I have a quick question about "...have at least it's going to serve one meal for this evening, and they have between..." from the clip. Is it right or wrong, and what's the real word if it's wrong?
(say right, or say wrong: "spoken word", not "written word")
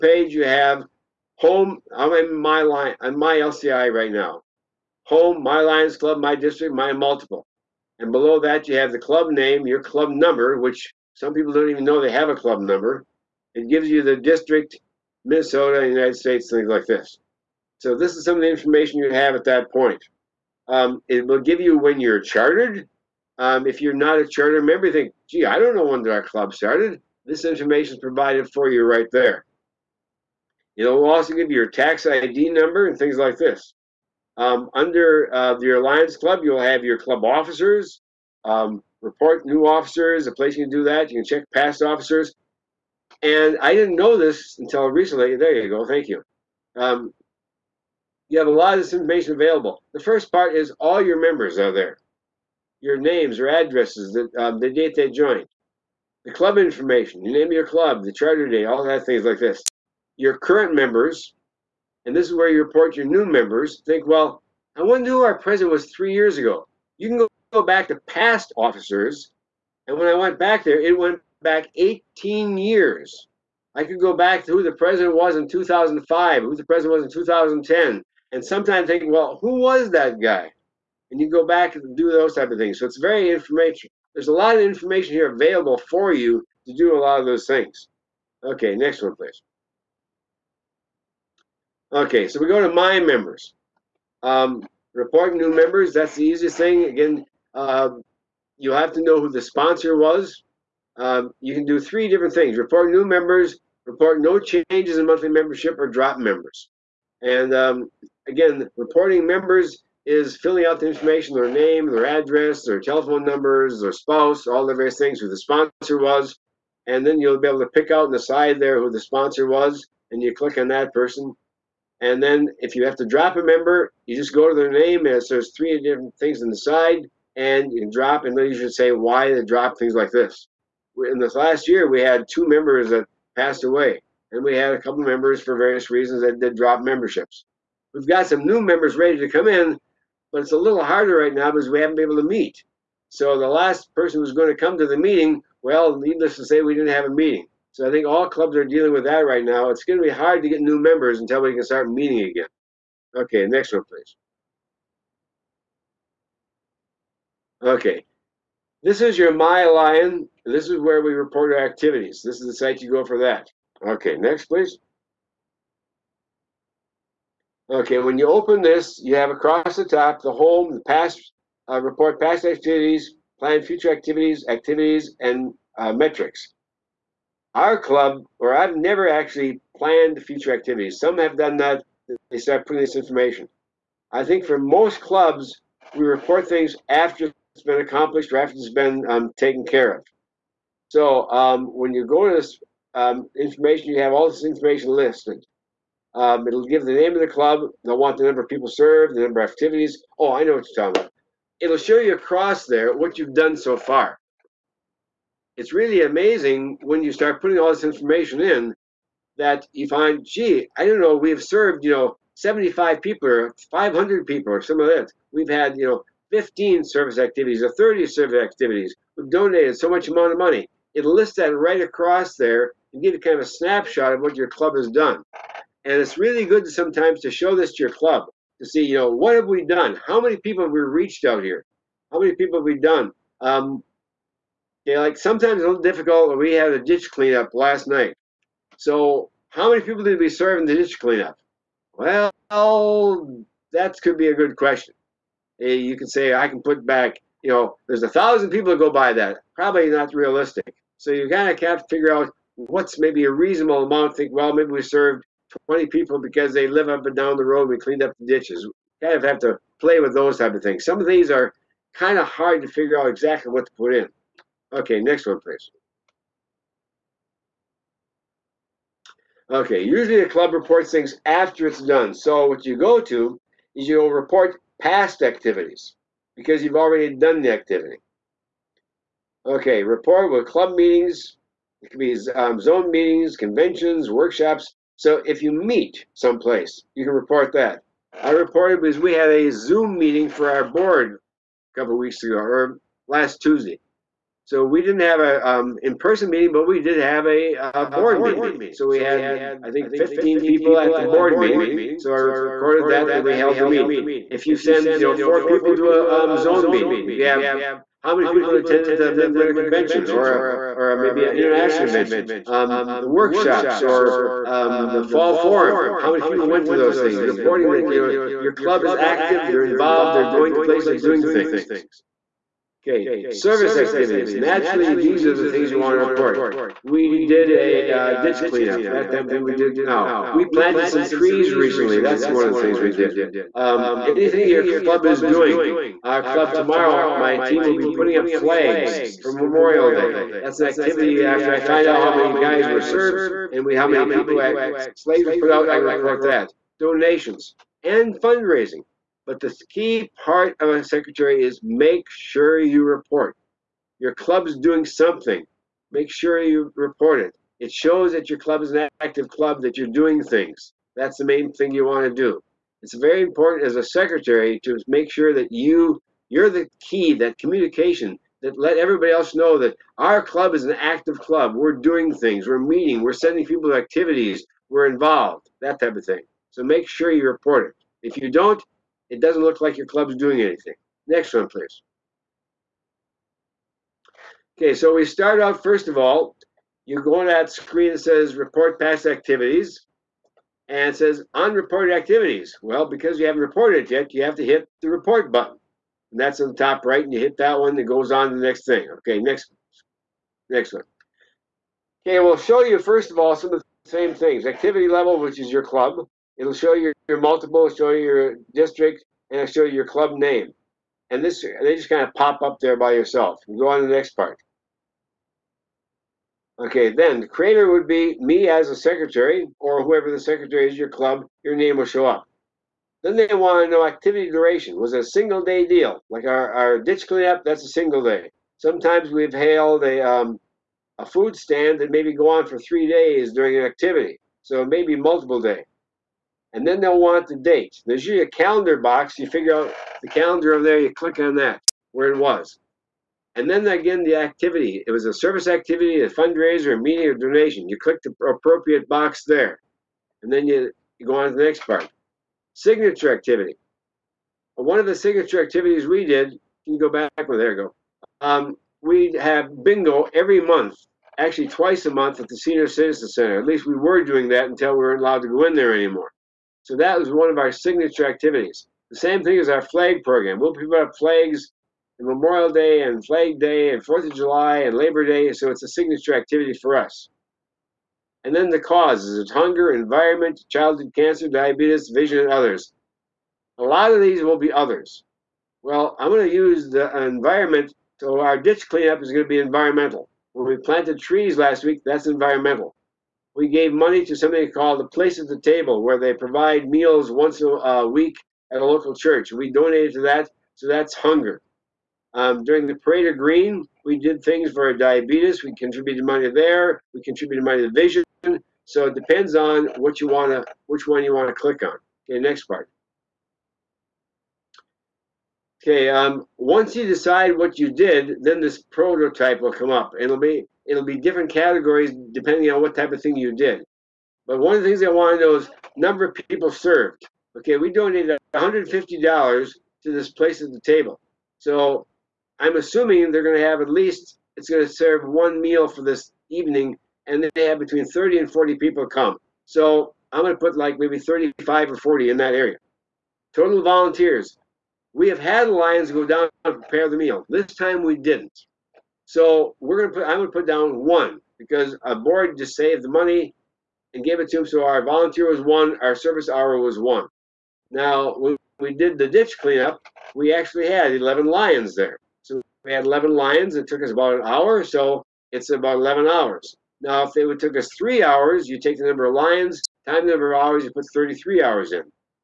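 right.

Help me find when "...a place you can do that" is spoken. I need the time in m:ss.
0:40.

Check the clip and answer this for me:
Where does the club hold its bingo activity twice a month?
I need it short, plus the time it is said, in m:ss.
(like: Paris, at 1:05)
Senior Citizen Center, at 7:42.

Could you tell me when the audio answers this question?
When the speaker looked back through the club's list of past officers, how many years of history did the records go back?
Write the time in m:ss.
1:11.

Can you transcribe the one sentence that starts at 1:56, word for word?
And then you'll be able to pick out on the side there who the sponsor was, and you click on that person.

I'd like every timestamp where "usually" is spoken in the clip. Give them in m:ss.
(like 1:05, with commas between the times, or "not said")
4:29, 7:18.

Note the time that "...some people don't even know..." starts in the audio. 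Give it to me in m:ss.
0:11.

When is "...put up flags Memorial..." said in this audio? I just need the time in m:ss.
7:50.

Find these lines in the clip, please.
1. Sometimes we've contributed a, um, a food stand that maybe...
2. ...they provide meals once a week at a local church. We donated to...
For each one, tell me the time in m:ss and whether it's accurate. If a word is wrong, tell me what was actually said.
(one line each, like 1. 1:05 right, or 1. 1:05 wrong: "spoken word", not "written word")
1. 7:08 wrong: "hailed", not "contributed"
2. 8:15 right.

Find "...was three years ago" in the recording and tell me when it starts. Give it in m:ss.
1:05.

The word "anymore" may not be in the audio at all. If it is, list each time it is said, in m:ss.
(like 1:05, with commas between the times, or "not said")
7:45.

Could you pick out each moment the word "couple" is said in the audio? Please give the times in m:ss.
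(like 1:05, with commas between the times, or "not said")
2:14, 4:51.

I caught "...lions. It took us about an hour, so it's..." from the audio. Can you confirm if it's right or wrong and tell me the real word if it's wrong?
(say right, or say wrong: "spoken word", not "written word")
right.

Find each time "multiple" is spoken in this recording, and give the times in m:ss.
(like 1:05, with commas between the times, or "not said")
0:06, 6:47, 7:14.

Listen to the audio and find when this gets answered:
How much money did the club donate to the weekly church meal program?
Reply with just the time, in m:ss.
8:48.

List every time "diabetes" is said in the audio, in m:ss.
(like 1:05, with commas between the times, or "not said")
8:01, 8:24.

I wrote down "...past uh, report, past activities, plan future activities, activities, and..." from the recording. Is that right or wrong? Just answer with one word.
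right.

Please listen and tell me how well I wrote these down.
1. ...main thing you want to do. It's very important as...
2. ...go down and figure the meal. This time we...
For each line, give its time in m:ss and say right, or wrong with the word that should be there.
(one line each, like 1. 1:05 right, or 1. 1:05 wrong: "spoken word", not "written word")
1. 6:01 right
2. 9:05 wrong: "prepare", not "figure".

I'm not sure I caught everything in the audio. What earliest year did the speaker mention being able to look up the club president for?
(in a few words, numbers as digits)
2005.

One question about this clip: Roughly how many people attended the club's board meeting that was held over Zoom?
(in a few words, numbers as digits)
15.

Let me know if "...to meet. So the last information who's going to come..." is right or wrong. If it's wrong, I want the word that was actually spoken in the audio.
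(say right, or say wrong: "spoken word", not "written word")
wrong: "person", not "information".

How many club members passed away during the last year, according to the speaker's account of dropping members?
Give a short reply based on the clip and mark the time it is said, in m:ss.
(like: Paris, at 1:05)
2, at 2:12.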